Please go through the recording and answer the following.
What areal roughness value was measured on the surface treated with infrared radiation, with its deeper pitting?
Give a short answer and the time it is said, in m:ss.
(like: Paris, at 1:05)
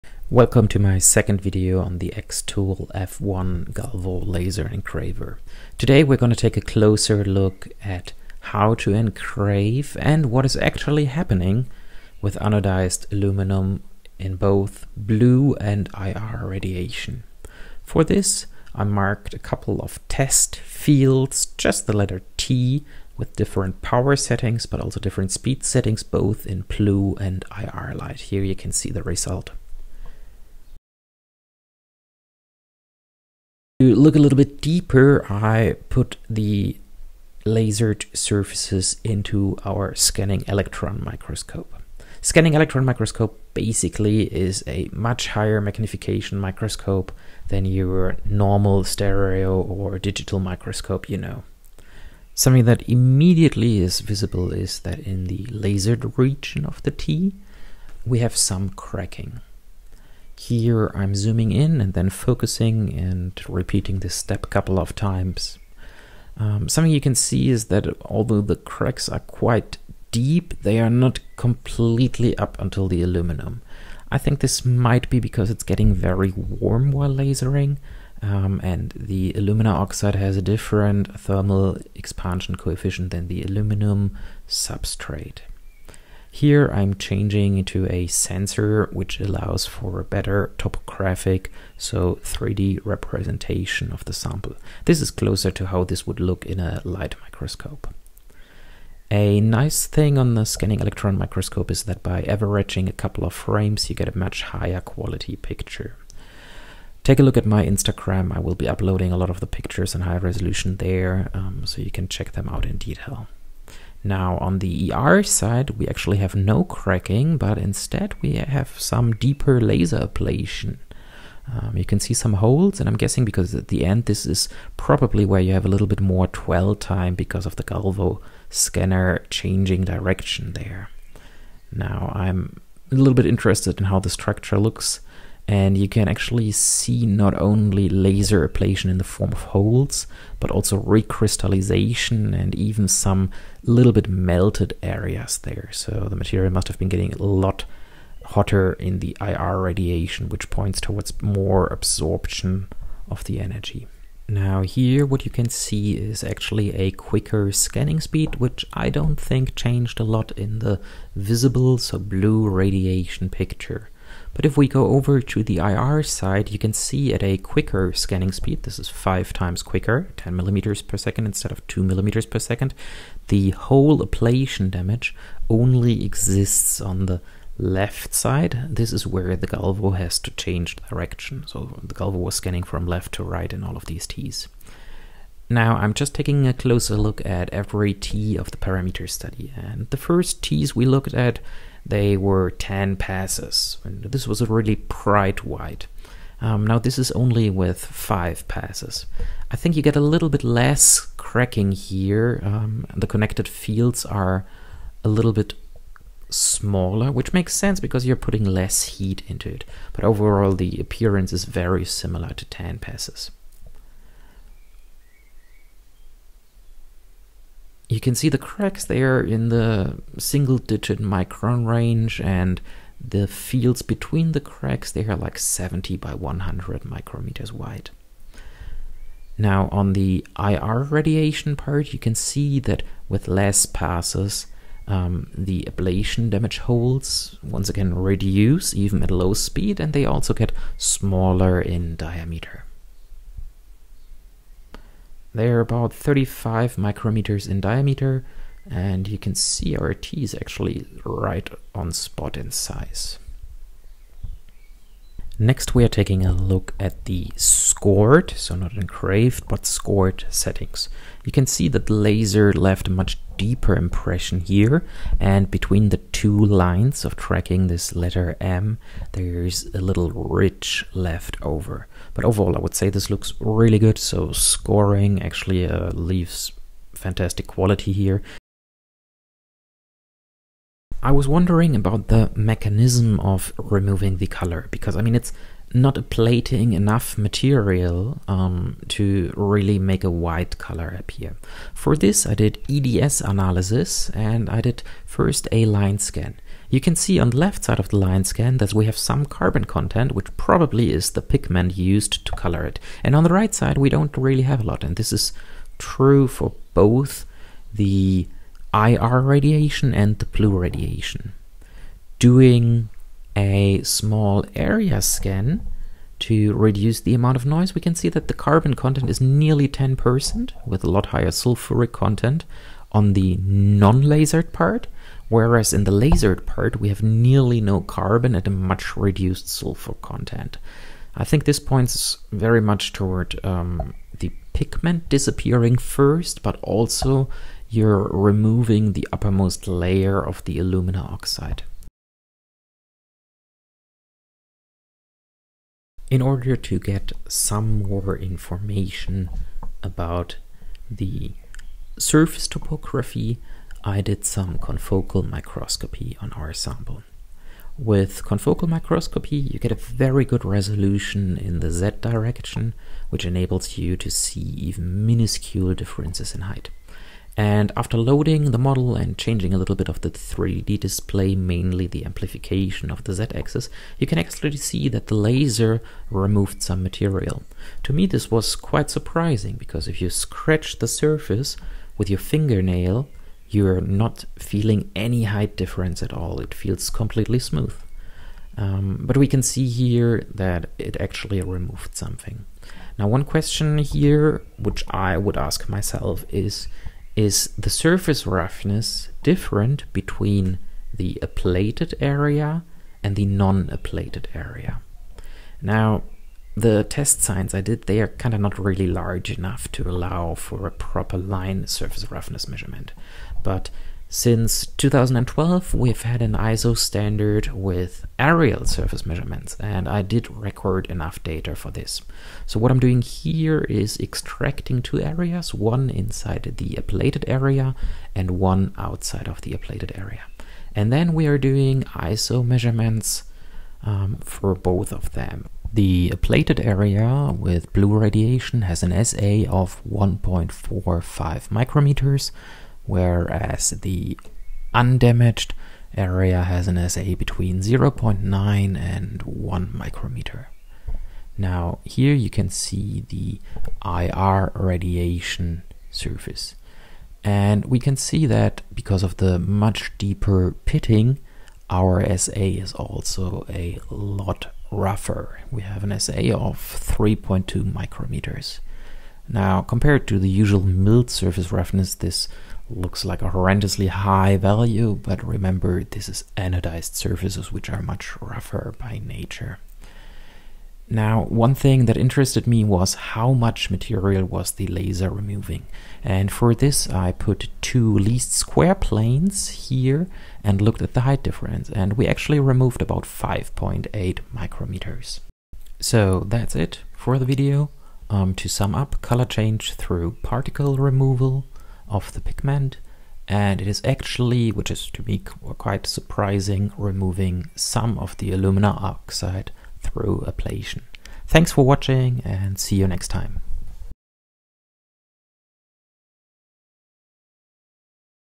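3.2 micrometers, at 7:46.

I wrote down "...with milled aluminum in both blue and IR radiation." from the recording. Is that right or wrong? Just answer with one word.
wrong.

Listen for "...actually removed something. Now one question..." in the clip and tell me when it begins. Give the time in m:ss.
6:30.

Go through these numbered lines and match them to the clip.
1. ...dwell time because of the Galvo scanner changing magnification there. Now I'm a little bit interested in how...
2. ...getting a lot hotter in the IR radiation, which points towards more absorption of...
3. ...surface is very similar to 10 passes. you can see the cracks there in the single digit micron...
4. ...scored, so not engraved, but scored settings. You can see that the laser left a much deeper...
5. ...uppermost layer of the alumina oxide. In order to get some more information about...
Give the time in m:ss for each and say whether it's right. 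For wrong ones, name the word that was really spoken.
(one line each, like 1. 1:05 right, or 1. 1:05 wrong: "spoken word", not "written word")
1. 2:06 wrong: "direction", not "magnification"
2. 2:26 right
3. 3:30 wrong: "appearance", not "surface"
4. 4:17 right
5. 5:39 right.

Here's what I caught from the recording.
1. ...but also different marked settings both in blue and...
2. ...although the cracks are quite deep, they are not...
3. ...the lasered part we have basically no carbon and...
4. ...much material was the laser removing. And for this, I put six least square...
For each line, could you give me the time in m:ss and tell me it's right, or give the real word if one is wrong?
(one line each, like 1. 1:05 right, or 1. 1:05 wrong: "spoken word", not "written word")
1. 0:24 wrong: "speed", not "marked"
2. 1:08 right
3. 5:25 wrong: "nearly", not "basically"
4. 8:03 wrong: "two", not "six".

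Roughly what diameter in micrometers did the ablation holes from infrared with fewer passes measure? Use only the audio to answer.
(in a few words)
35 micrometers.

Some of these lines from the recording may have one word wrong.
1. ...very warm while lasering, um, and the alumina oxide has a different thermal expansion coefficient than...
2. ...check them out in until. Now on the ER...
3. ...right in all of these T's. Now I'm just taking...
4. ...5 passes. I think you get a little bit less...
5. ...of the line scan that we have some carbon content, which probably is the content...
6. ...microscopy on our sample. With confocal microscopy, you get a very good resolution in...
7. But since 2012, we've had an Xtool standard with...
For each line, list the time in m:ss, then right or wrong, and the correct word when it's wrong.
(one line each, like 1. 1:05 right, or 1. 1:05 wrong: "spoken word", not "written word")
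1. 1:15 right
2. 1:52 wrong: "detail", not "until"
3. 3:03 right
4. 3:17 right
5. 4:57 wrong: "pigment", not "content"
6. 5:55 right
7. 6:53 wrong: "ISO", not "Xtool".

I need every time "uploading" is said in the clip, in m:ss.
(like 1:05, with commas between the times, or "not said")
1:48.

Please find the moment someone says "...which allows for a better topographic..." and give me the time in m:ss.
1:28.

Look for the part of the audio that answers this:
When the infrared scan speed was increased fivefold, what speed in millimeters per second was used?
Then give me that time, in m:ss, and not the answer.
2:50.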